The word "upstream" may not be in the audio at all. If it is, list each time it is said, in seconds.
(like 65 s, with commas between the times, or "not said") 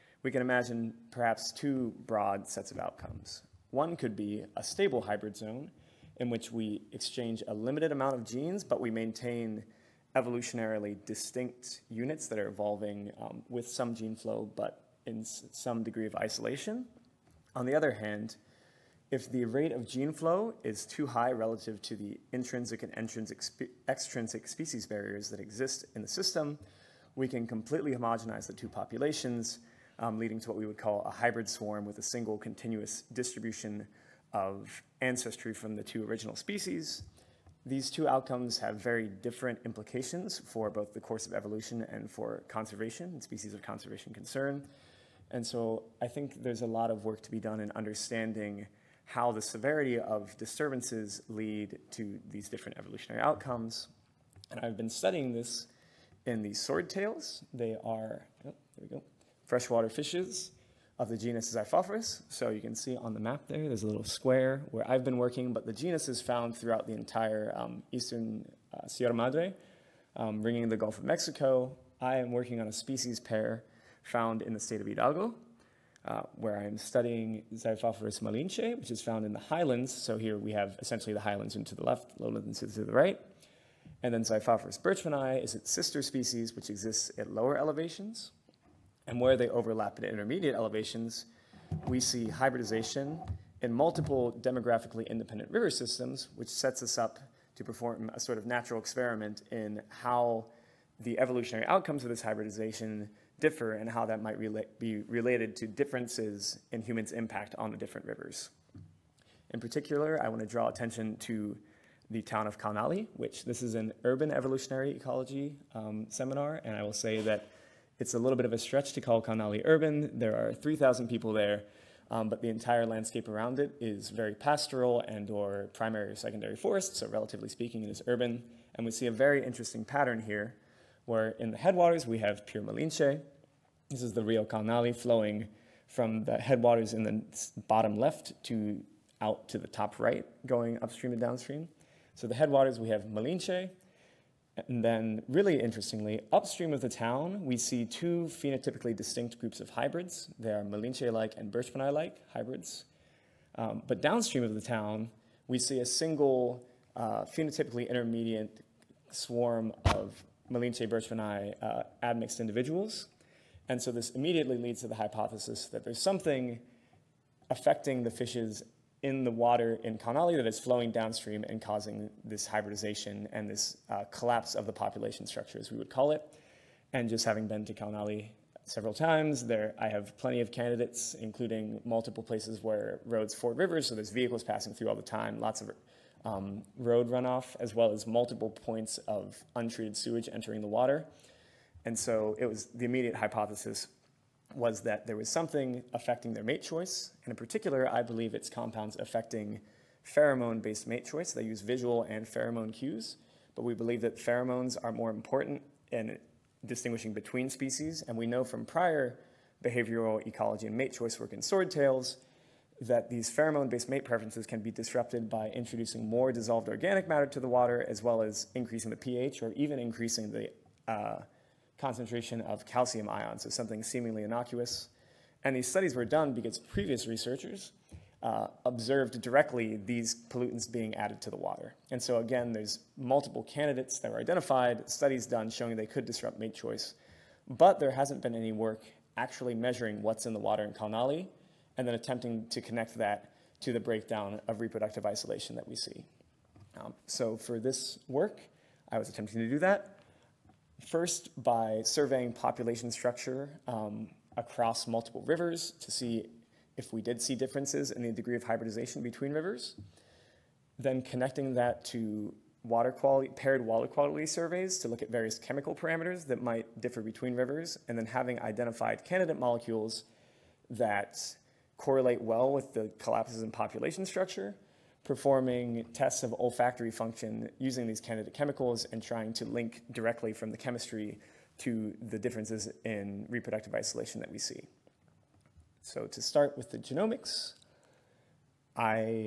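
140 s, 146 s.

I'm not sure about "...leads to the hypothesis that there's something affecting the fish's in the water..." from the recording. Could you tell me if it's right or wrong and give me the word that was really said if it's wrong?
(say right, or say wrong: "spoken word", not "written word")
right.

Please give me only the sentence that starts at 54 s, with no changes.
And I've been studying this in the swordtails.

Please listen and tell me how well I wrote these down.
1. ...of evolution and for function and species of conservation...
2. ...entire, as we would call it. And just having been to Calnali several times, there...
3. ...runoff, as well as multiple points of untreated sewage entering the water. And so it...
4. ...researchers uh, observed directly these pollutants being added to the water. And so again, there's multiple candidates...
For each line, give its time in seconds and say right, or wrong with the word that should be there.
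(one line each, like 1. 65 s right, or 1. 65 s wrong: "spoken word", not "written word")
1. 41 s wrong: "conservation", not "function"
2. 175 s wrong: "structure", not "entire"
3. 187 s right
4. 227 s right.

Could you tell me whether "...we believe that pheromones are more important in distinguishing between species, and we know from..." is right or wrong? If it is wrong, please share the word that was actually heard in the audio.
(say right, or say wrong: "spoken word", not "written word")
right.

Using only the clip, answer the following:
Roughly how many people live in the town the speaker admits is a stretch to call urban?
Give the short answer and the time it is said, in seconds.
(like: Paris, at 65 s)
3000, at 120 s.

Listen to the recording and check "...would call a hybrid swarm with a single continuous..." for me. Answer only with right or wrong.
right.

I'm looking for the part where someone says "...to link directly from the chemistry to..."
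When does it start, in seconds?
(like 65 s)
279 s.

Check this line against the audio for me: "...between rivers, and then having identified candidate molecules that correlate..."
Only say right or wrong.
right.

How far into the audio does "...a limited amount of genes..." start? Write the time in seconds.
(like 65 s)
7 s.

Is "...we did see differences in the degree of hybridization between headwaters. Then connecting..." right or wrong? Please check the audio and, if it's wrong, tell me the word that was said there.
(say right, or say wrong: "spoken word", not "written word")
wrong: "rivers", not "headwaters".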